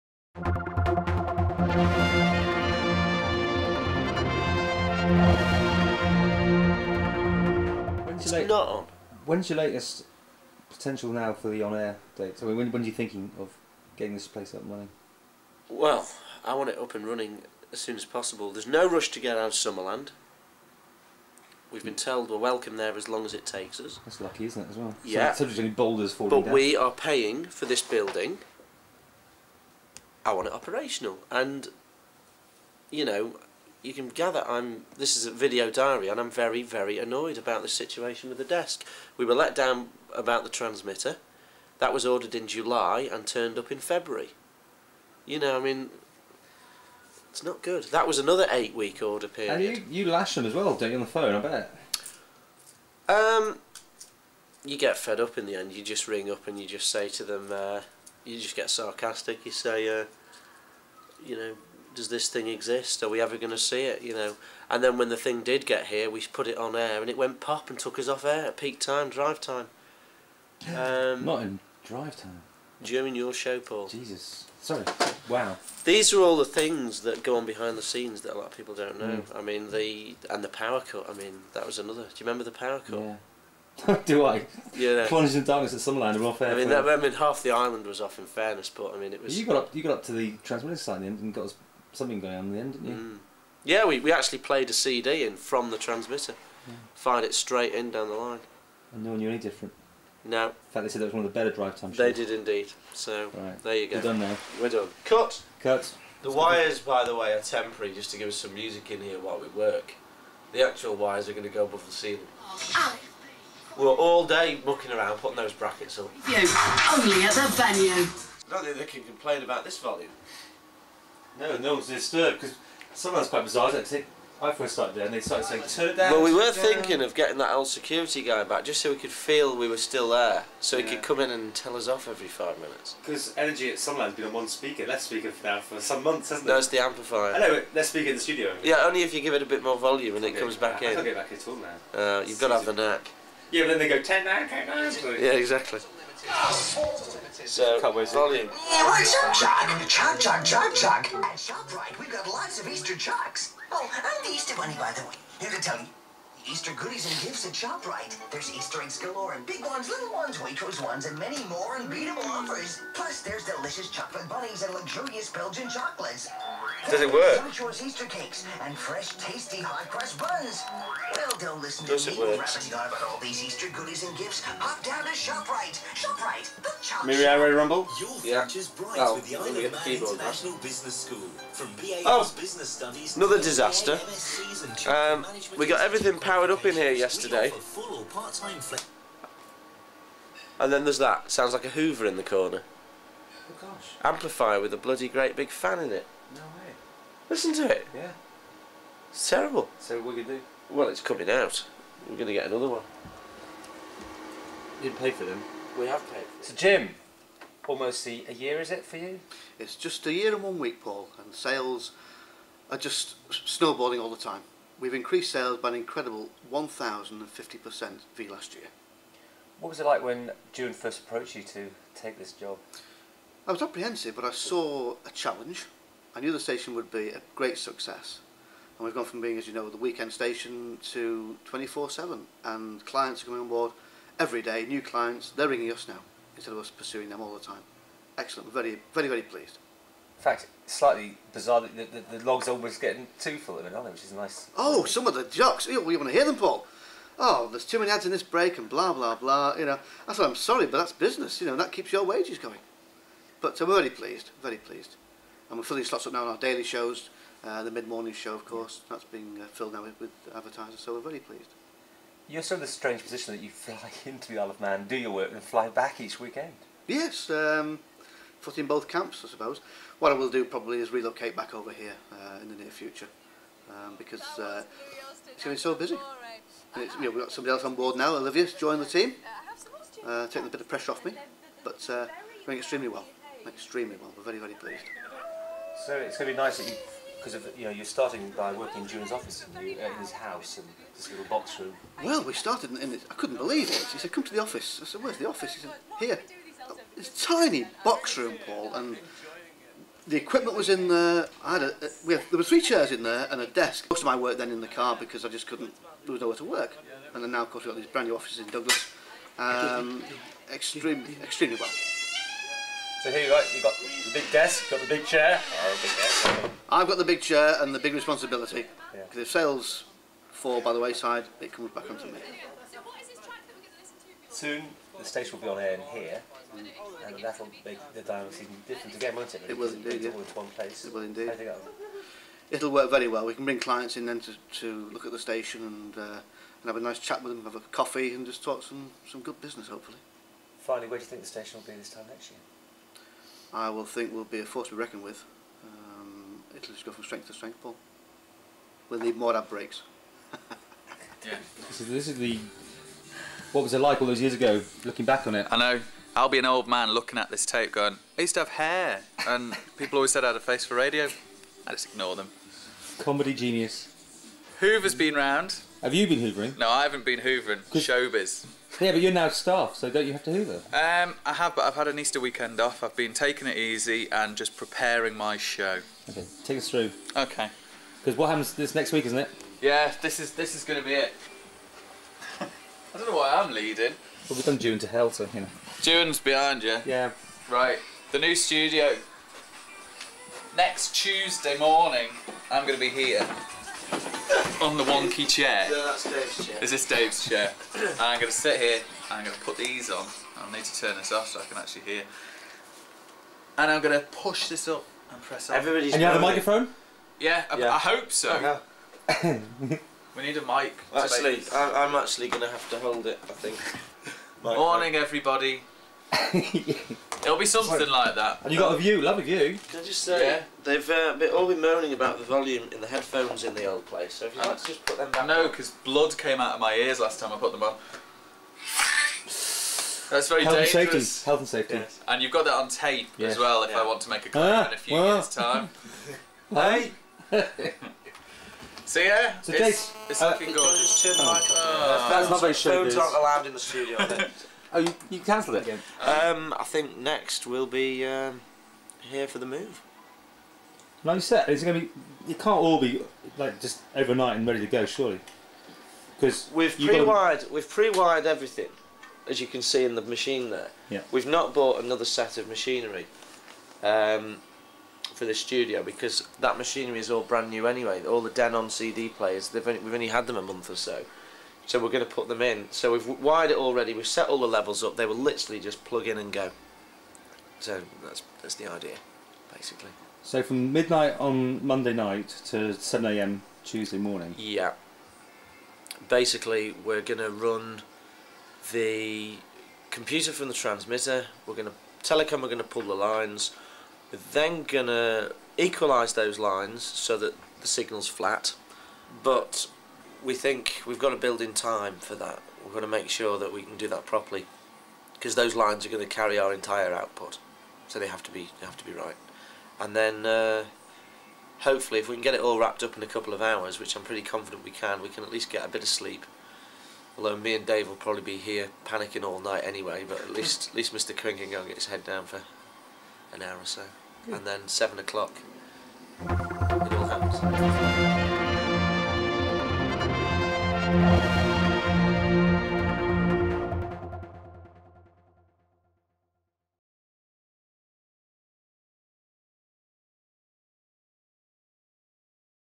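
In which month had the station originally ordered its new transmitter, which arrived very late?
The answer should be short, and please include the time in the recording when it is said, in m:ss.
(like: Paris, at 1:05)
July, at 0:42.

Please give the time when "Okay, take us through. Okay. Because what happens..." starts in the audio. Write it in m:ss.
6:16.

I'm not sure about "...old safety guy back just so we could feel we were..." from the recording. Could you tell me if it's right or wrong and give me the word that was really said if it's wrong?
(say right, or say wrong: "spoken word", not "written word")
wrong: "security", not "safety".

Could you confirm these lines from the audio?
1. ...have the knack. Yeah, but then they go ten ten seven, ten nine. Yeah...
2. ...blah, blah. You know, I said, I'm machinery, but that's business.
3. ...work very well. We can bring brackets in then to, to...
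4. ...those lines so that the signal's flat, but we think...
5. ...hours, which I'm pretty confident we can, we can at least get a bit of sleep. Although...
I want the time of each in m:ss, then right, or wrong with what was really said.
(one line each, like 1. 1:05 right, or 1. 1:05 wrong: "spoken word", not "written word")
1. 2:22 wrong: "nine", not "seven"
2. 4:08 wrong: "sorry", not "machinery"
3. 5:32 wrong: "clients", not "brackets"
4. 8:16 right
5. 8:33 right.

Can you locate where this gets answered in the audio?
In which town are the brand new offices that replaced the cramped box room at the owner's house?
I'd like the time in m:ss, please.
5:08.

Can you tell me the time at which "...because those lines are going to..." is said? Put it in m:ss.
8:25.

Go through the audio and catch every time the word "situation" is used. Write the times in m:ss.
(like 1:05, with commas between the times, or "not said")
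0:37.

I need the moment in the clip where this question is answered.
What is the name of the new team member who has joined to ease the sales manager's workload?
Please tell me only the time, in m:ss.
4:38.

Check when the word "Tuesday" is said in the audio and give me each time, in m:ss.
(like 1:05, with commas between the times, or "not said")
6:30, 8:03.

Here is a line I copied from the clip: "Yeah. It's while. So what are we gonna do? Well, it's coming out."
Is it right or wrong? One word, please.
wrong.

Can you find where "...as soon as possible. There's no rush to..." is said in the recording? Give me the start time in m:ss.
0:17.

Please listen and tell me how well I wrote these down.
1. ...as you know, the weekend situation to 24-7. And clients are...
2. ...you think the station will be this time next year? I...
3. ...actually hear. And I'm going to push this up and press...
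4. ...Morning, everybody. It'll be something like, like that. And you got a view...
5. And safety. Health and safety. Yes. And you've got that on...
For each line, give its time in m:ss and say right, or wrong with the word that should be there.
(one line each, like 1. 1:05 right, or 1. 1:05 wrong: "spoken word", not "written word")
1. 3:49 wrong: "station", not "situation"
2. 5:41 right
3. 6:41 right
4. 6:54 right
5. 7:10 right.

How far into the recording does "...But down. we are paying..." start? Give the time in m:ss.
0:26.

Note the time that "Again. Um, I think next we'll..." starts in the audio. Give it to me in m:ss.
7:25.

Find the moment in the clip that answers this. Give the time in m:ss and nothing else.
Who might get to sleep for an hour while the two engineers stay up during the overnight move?
8:40.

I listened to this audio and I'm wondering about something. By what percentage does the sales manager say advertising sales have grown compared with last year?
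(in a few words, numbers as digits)
1,050%.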